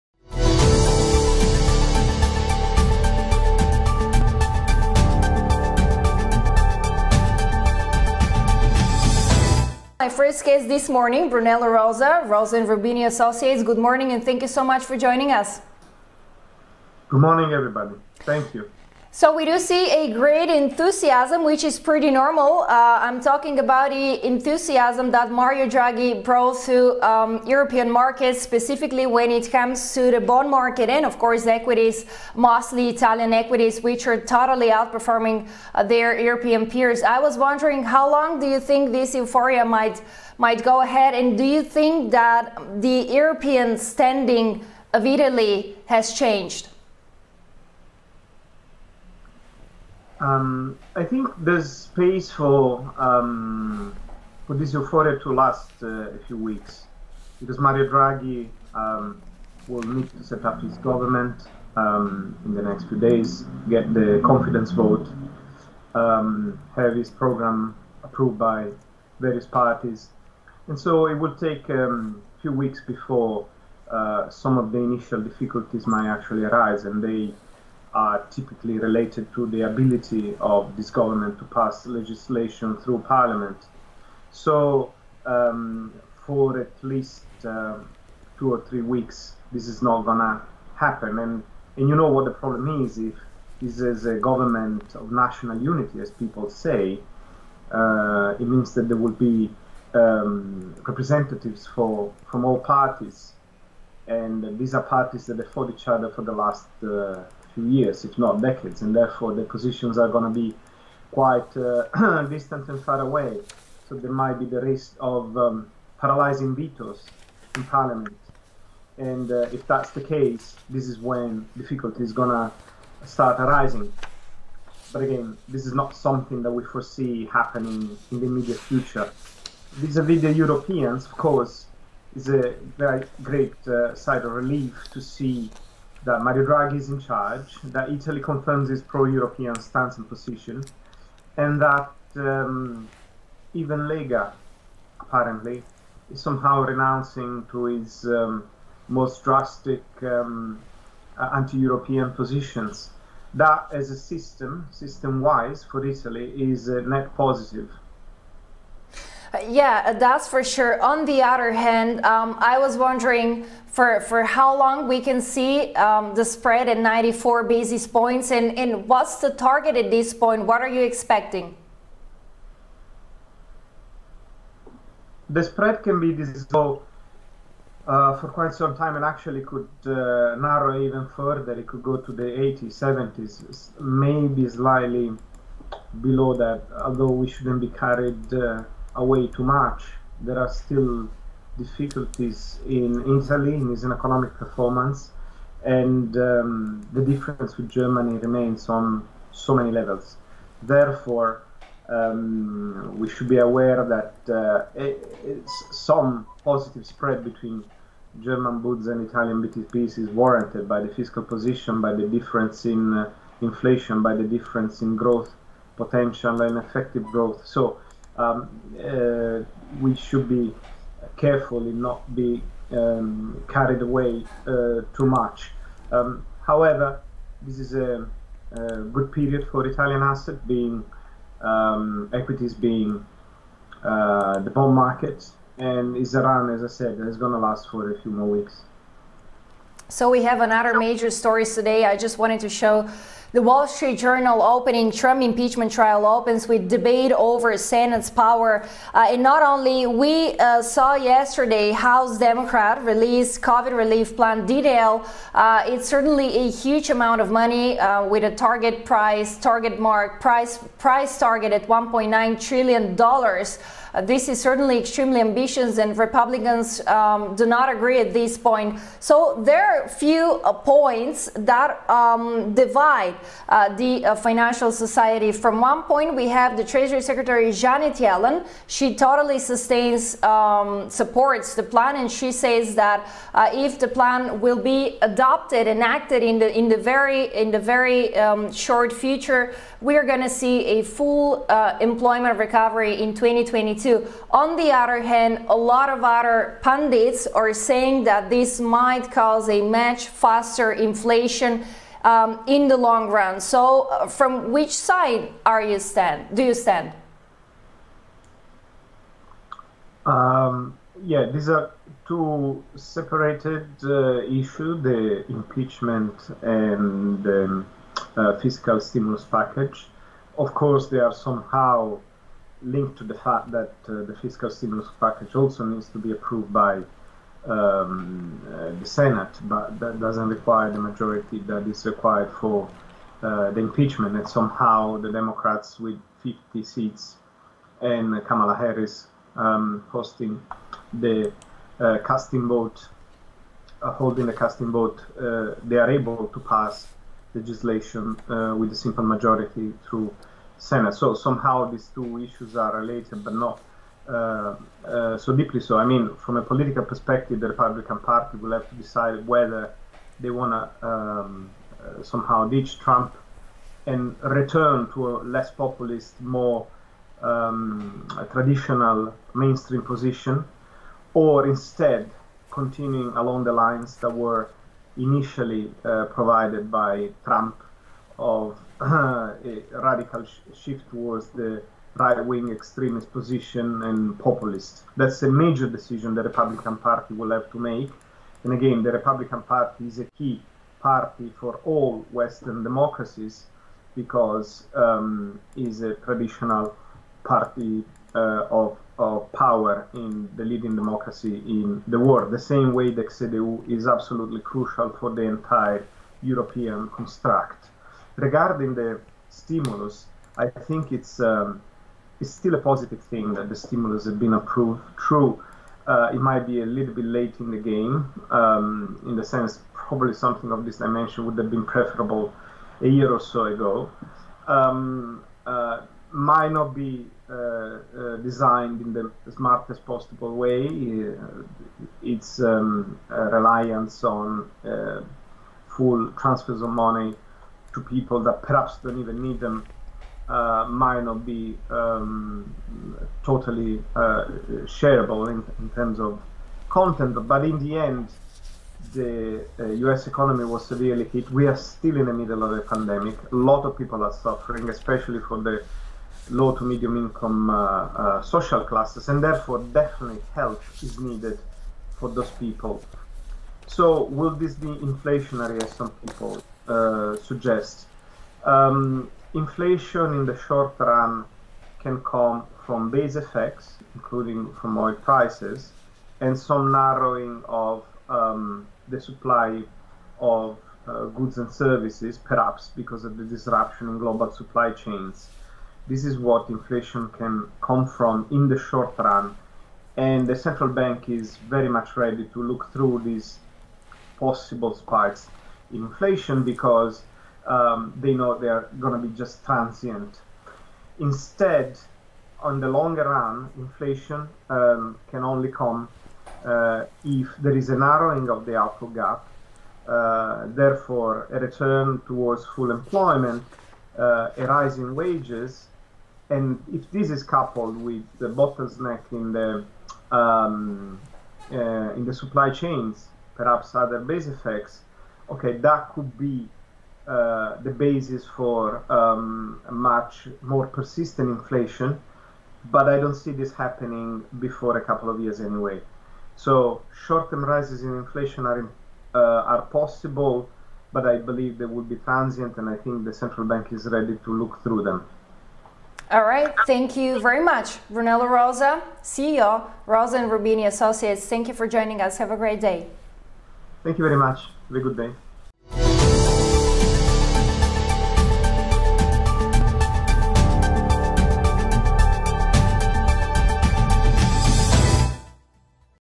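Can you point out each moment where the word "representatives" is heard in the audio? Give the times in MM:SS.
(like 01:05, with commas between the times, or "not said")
01:40.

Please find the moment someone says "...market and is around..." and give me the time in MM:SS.
03:54.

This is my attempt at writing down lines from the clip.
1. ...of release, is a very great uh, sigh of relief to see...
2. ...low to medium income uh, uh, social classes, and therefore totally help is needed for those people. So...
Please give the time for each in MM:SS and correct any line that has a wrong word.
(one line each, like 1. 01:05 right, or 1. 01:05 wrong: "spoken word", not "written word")
1. 02:11 wrong: "course", not "release"
2. 07:36 wrong: "definitely", not "totally".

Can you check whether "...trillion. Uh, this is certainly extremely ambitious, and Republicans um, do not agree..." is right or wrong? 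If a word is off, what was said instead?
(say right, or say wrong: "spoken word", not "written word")
right.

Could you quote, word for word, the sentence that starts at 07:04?
Um, uh, might not be uh, uh, designed in the smartest possible way.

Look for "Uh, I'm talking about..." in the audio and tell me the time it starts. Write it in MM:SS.
00:22.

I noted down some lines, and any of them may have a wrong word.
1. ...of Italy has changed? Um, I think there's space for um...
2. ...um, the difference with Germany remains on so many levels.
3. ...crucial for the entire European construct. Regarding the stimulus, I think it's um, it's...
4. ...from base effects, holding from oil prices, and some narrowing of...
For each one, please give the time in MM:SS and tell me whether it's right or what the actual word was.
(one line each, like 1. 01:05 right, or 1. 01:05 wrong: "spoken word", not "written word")
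1. 00:44 right
2. 03:16 right
3. 06:44 right
4. 07:52 wrong: "including", not "holding".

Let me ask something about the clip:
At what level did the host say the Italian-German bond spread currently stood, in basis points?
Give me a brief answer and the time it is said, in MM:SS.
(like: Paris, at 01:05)
94, at 02:46.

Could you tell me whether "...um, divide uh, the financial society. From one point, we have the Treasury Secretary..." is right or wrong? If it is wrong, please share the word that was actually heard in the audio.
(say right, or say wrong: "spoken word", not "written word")
right.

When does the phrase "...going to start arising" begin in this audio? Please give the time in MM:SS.
02:02.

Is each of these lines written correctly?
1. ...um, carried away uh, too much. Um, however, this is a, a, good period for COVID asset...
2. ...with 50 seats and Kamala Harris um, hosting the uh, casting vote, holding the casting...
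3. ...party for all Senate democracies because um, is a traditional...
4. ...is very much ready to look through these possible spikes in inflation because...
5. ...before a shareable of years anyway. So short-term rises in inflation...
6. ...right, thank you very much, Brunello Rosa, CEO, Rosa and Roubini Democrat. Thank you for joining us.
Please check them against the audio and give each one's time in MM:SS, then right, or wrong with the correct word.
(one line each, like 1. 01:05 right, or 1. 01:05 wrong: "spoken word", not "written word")
1. 03:42 wrong: "Italian", not "COVID"
2. 05:35 right
3. 06:30 wrong: "Western", not "Senate"
4. 08:11 right
5. 08:54 wrong: "couple", not "shareable"
6. 09:06 wrong: "Associates", not "Democrat".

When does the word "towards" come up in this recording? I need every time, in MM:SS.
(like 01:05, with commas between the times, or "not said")
06:20, 08:32.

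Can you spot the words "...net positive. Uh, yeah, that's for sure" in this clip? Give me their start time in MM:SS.
02:36.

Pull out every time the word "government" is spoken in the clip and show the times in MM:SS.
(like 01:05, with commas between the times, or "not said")
01:00, 01:20, 01:34.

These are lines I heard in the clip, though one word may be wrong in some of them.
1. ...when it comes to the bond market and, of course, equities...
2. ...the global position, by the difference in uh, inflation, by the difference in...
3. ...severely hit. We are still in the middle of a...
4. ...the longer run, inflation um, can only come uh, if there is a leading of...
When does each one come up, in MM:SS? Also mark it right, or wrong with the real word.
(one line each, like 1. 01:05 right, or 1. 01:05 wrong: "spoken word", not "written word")
1. 00:29 right
2. 03:30 wrong: "fiscal", not "global"
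3. 07:30 right
4. 08:22 wrong: "narrowing", not "leading".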